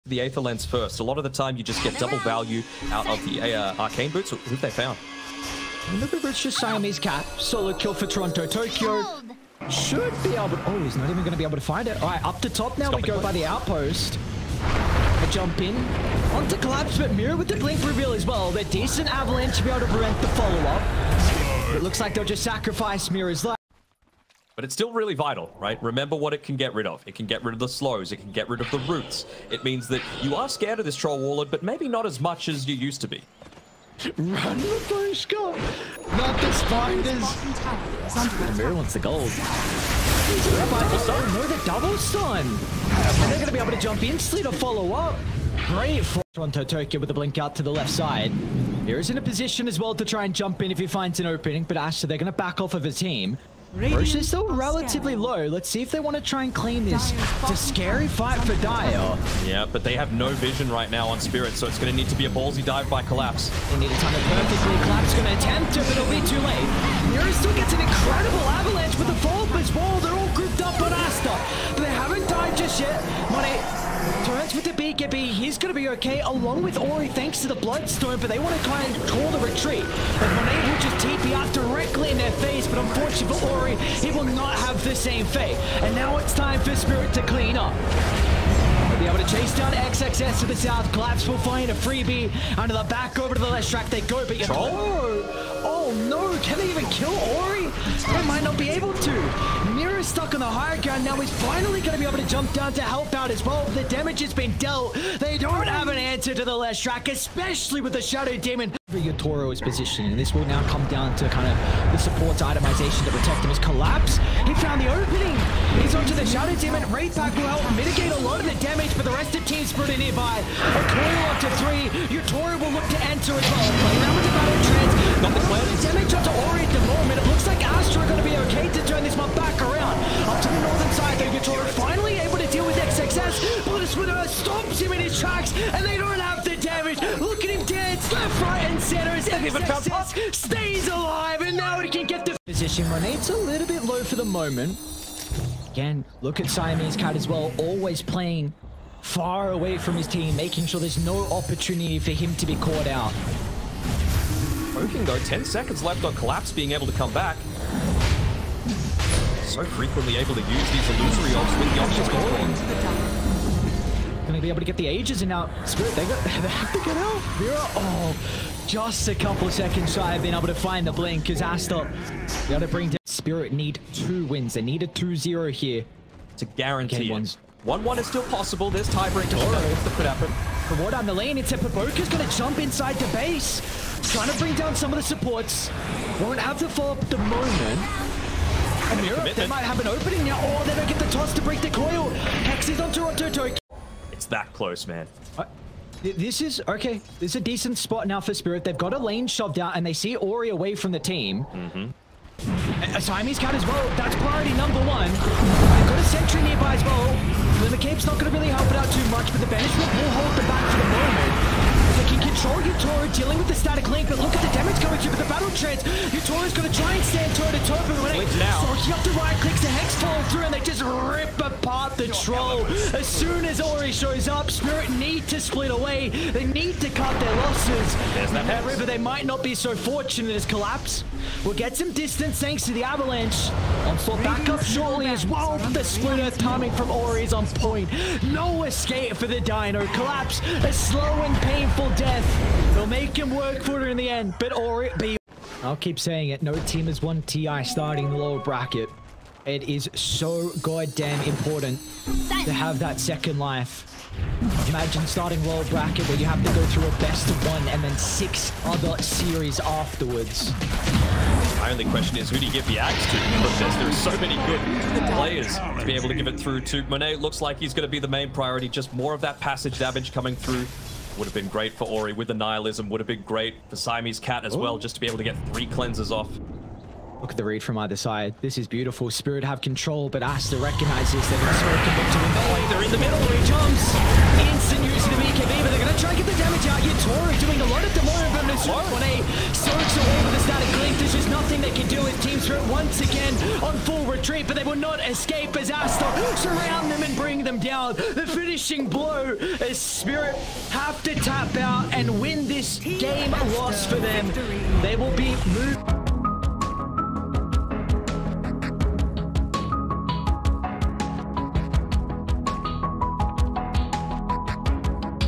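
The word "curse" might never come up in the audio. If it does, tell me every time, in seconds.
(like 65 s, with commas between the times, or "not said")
not said.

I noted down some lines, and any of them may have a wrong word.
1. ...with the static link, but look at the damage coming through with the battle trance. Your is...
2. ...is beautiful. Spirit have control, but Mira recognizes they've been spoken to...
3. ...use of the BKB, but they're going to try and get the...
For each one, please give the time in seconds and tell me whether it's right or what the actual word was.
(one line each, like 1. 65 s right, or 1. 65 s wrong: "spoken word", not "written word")
1. 213 s right
2. 278 s wrong: "Aster", not "Mira"
3. 284 s right.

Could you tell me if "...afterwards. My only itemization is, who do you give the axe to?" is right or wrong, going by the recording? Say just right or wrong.
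wrong.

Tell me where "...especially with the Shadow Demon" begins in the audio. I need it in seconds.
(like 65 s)
107 s.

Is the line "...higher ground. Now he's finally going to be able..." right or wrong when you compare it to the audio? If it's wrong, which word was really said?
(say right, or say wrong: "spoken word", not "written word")
right.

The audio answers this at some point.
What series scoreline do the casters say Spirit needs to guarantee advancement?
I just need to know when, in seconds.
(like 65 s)
174 s.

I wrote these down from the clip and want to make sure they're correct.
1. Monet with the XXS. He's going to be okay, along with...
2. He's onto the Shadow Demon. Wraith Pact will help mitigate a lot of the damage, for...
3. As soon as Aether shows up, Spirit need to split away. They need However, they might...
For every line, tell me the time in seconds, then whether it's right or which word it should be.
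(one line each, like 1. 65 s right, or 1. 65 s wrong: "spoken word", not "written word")
1. 73 s wrong: "BKB", not "XXS"
2. 115 s right
3. 222 s wrong: "Ori", not "Aether".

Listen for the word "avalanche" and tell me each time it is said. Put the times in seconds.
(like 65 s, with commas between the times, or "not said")
19 s, 68 s, 232 s.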